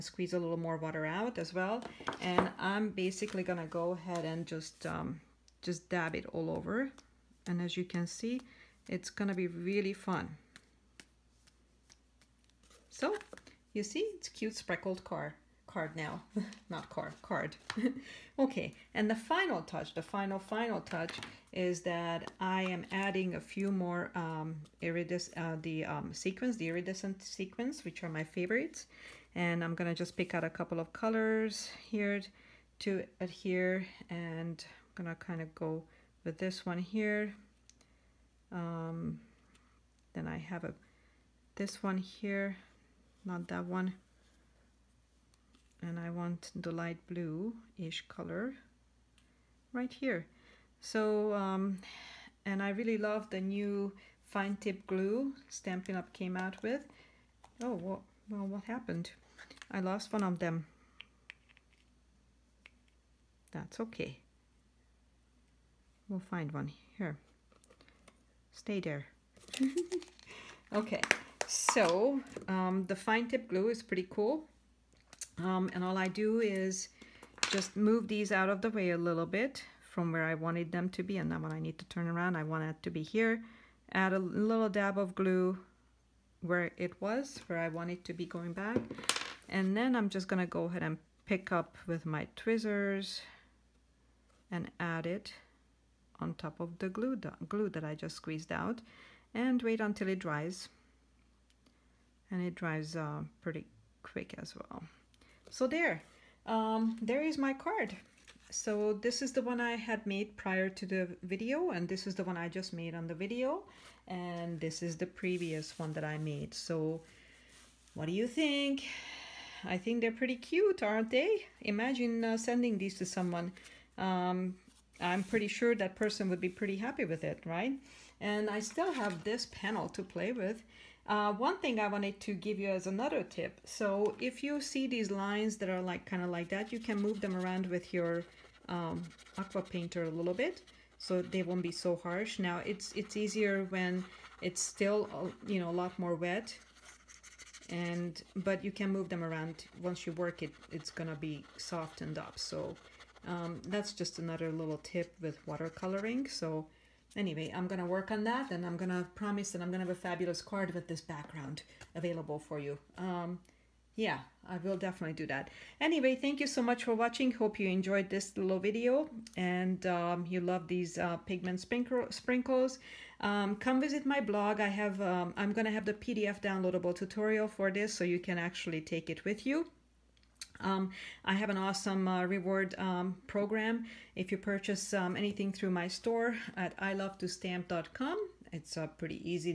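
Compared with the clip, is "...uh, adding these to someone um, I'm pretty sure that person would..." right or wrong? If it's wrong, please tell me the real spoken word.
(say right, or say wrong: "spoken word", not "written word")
wrong: "sending", not "adding".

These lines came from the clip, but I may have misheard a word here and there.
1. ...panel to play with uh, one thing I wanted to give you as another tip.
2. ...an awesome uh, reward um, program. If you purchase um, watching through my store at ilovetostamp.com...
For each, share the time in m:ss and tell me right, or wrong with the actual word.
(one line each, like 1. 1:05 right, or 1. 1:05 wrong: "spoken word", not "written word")
1. 2:09 right
2. 3:01 wrong: "anything", not "watching".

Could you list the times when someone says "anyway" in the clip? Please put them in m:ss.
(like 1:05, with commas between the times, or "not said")
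2:37, 2:45.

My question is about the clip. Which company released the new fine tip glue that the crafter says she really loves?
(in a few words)
Stampin' Up!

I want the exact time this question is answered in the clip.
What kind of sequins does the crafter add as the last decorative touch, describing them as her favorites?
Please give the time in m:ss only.
0:26.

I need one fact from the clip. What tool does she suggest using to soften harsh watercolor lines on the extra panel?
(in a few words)
aqua painter.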